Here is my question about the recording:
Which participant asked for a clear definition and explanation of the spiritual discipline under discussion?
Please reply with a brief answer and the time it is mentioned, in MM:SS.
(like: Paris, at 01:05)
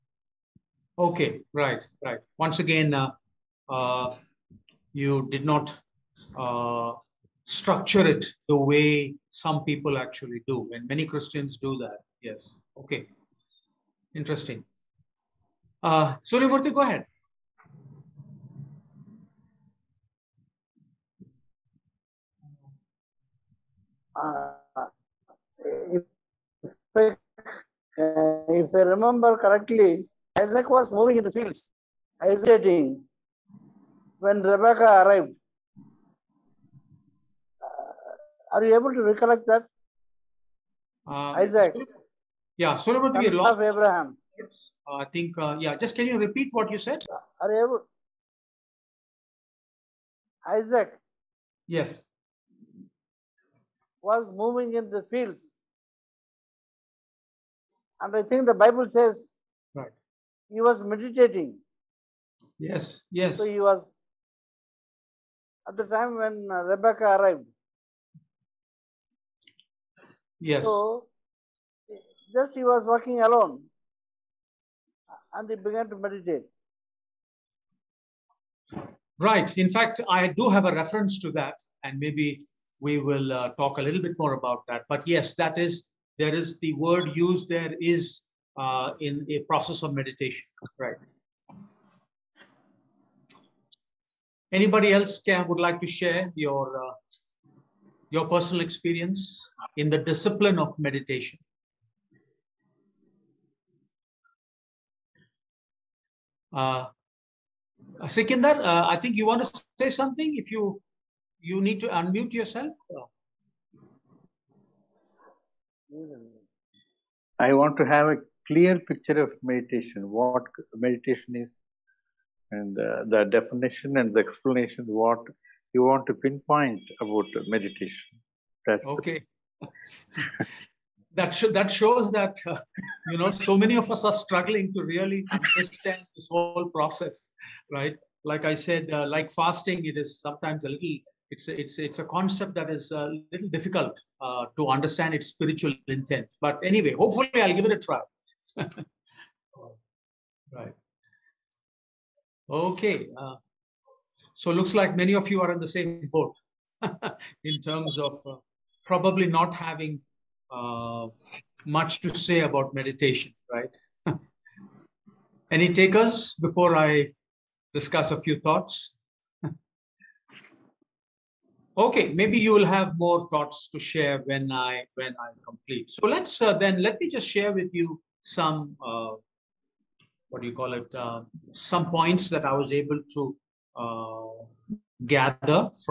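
Sikindar, at 01:48.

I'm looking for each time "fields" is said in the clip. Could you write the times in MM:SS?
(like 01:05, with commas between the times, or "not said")
00:31, 00:55.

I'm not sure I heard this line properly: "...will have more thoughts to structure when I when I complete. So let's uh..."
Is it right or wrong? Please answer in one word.
wrong.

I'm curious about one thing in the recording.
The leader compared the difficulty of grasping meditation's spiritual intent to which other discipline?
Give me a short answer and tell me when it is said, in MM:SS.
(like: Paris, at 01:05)
Fasting, at 02:19.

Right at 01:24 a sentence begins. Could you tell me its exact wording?
But yes, that is there is the word used there is uh, in a process of meditation.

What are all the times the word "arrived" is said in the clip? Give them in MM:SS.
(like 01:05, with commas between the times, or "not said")
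00:35, 01:07.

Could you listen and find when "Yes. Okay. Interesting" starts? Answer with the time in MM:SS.
00:12.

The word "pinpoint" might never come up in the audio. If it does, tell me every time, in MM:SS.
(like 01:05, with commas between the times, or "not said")
02:06.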